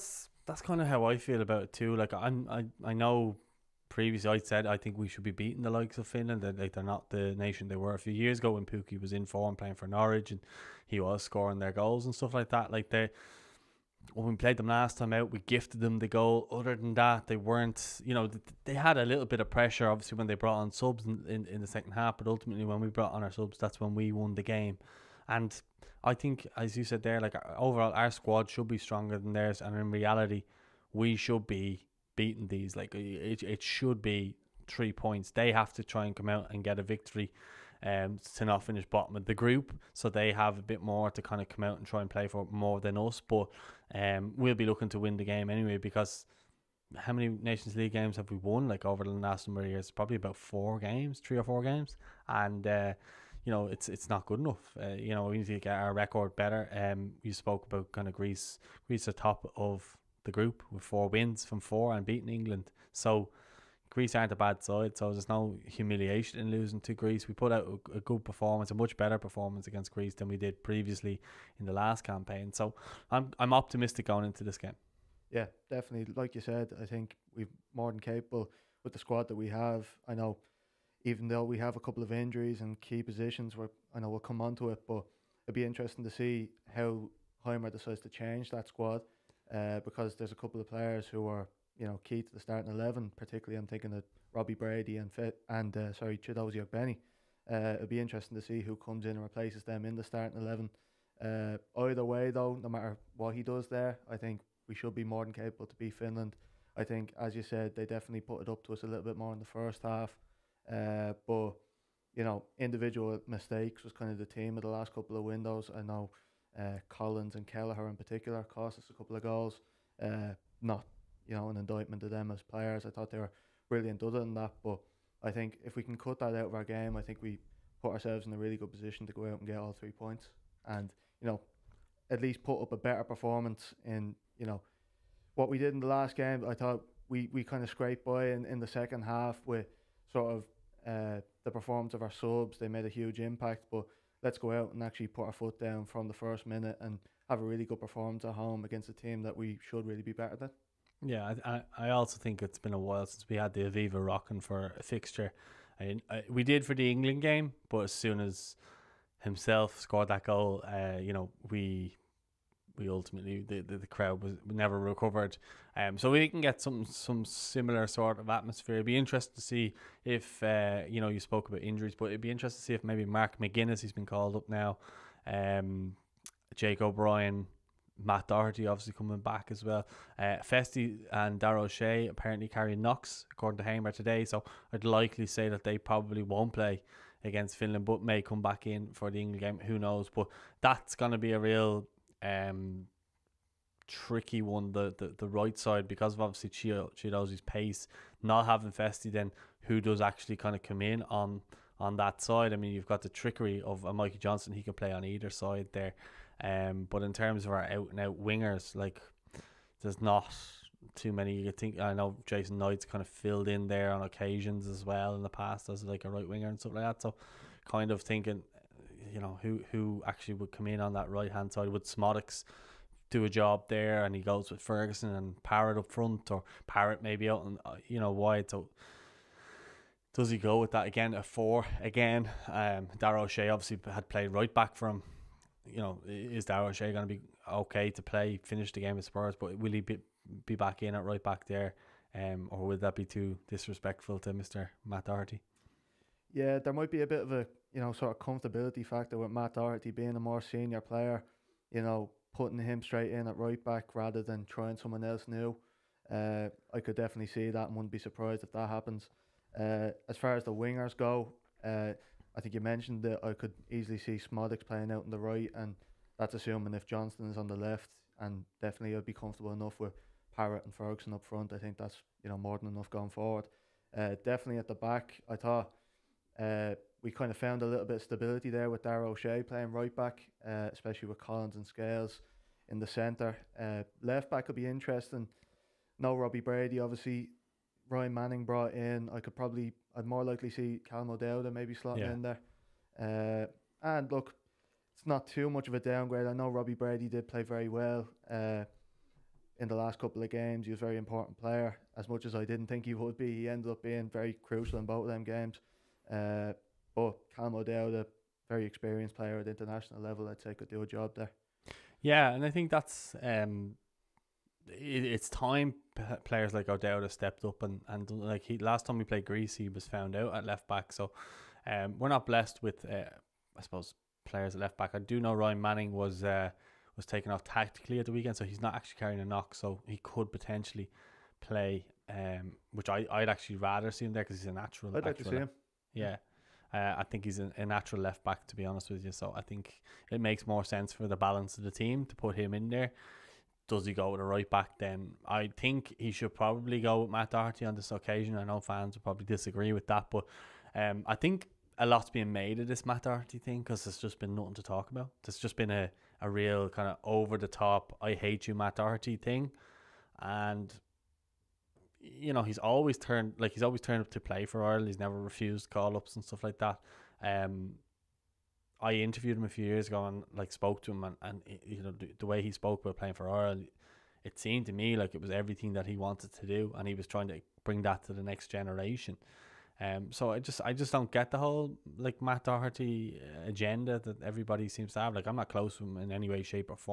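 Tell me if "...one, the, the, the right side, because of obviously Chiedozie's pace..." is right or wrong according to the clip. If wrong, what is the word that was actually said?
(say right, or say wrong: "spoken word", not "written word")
right.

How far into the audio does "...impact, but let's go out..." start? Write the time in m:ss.
2:23.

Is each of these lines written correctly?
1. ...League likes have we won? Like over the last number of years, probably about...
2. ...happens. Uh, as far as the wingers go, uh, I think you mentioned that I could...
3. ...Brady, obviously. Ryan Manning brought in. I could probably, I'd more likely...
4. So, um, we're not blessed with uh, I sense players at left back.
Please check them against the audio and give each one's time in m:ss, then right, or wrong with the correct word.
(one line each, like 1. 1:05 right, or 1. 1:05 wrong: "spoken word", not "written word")
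1. 0:47 wrong: "games", not "likes"
2. 4:18 right
3. 4:46 right
4. 5:20 wrong: "suppose", not "sense".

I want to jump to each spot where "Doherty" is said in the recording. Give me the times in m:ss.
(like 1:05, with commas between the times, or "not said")
2:58, 4:05, 4:09, 5:47, 5:53, 5:58, 6:22.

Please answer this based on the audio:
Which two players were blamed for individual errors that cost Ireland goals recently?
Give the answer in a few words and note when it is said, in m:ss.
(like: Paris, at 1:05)
Collins and Kelleher, at 1:56.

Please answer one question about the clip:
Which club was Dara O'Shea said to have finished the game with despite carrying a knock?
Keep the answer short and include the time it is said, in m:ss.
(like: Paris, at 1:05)
Spurs, at 3:59.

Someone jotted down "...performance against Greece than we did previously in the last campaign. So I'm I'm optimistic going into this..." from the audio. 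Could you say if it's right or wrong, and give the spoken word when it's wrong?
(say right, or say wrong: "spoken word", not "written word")
right.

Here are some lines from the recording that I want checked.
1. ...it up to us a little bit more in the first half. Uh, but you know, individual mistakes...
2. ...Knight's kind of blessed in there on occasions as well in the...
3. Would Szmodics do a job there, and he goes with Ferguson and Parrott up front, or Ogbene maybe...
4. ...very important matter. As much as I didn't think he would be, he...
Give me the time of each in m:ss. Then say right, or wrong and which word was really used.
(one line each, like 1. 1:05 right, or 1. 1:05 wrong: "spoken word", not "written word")
1. 1:48 right
2. 3:32 wrong: "filled", not "blessed"
3. 3:41 wrong: "Parrott", not "Ogbene"
4. 5:00 wrong: "player", not "matter".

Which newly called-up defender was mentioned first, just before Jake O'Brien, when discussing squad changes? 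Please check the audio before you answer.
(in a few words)
Mark McGuinness.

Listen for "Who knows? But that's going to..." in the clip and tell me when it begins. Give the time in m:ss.
3:09.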